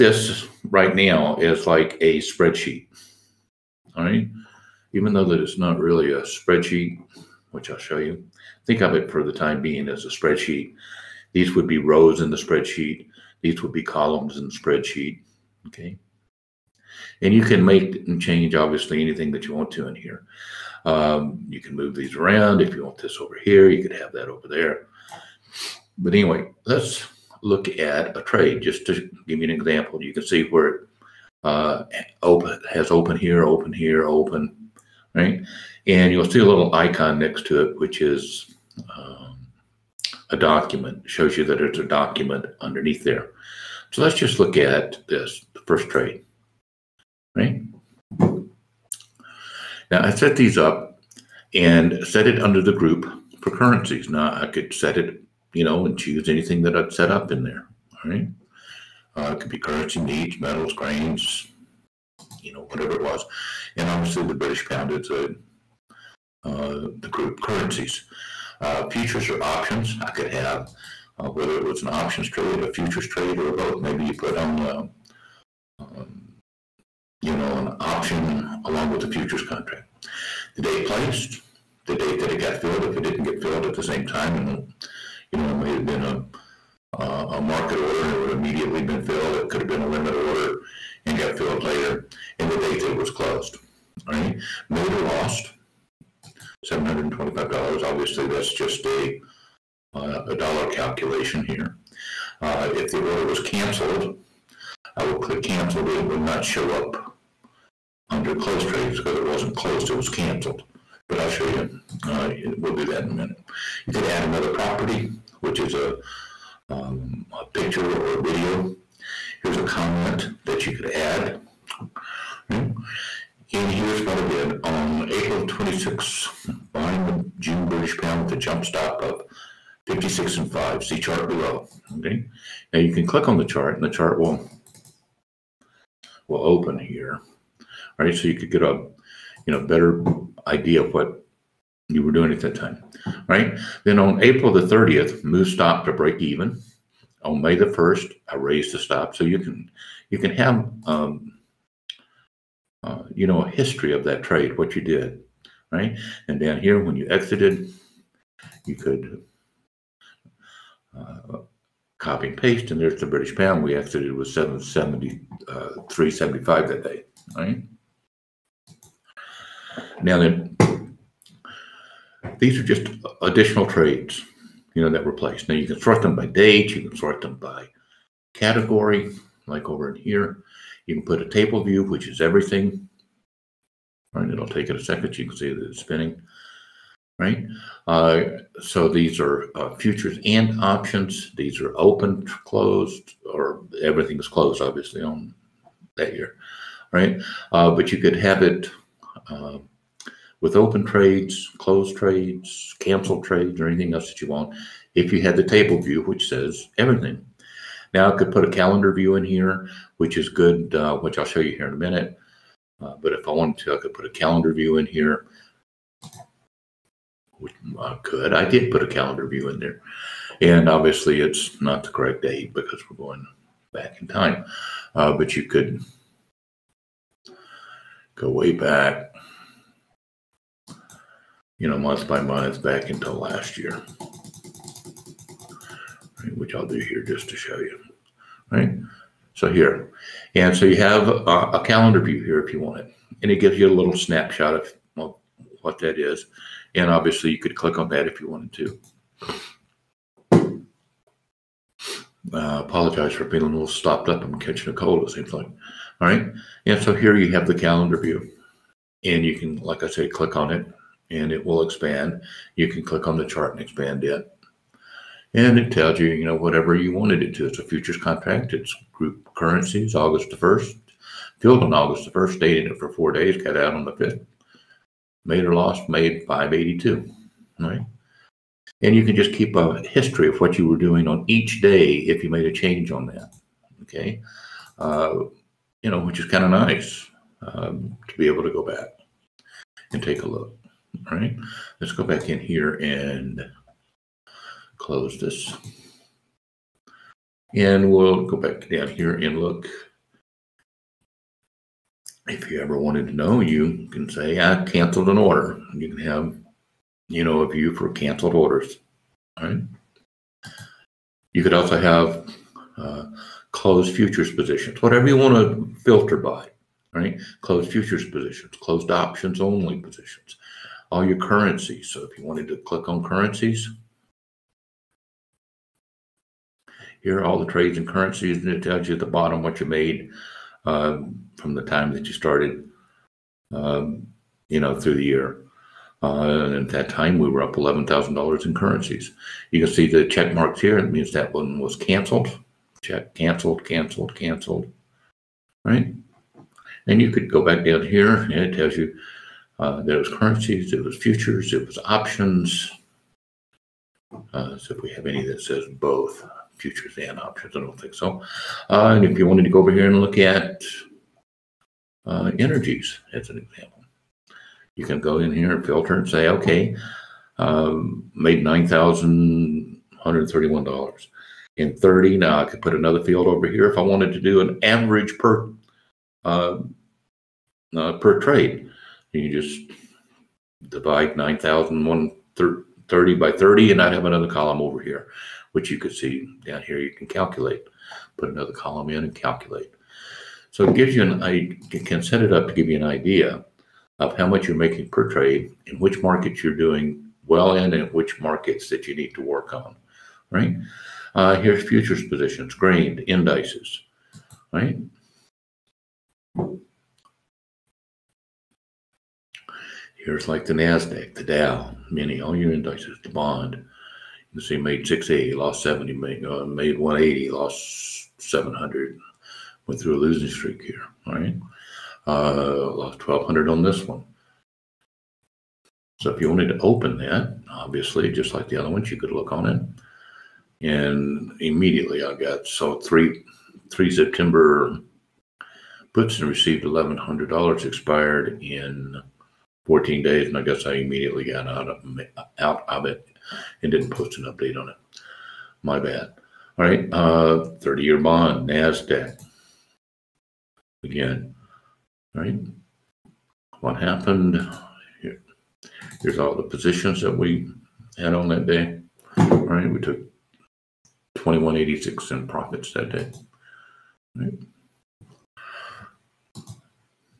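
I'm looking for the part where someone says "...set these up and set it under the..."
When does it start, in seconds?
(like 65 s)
50 s.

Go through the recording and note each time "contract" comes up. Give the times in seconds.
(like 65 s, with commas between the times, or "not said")
79 s, 267 s.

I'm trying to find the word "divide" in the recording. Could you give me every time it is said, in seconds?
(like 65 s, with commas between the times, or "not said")
380 s.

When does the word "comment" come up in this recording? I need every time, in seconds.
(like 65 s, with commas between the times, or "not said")
119 s.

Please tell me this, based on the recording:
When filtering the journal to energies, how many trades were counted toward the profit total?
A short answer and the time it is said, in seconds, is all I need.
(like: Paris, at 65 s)
30, at 371 s.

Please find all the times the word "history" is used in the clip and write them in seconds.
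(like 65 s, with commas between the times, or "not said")
153 s, 279 s.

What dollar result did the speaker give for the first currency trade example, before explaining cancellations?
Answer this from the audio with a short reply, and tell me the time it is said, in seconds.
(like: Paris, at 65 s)
$725, at 96 s.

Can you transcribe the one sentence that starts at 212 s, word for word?
Uh, but if I wanted to, I could put a calendar view in here.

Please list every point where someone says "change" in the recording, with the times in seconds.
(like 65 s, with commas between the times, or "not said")
18 s, 282 s.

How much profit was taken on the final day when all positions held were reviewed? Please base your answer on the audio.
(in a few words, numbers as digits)
$2,186.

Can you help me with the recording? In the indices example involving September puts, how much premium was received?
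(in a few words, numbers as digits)
$1,100.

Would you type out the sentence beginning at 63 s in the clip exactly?
And obviously the British pound is a, uh, the group currencies.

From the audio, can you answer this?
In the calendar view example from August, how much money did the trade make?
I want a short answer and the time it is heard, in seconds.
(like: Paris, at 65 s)
$582, at 275 s.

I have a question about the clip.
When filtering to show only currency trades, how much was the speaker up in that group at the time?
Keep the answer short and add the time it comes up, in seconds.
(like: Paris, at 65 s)
$11,000, at 337 s.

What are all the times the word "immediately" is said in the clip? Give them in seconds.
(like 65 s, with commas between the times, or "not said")
88 s, 431 s, 440 s.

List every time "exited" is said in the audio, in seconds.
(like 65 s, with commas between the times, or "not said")
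157 s, 163 s.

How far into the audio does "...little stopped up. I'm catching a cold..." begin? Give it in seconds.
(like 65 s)
253 s.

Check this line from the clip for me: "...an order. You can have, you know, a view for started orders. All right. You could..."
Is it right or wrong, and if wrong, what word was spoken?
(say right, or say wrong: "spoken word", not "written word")
wrong: "canceled", not "started".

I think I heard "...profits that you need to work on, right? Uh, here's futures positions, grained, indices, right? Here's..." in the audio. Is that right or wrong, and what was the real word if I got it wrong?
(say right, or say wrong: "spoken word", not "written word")
wrong: "markets", not "profits".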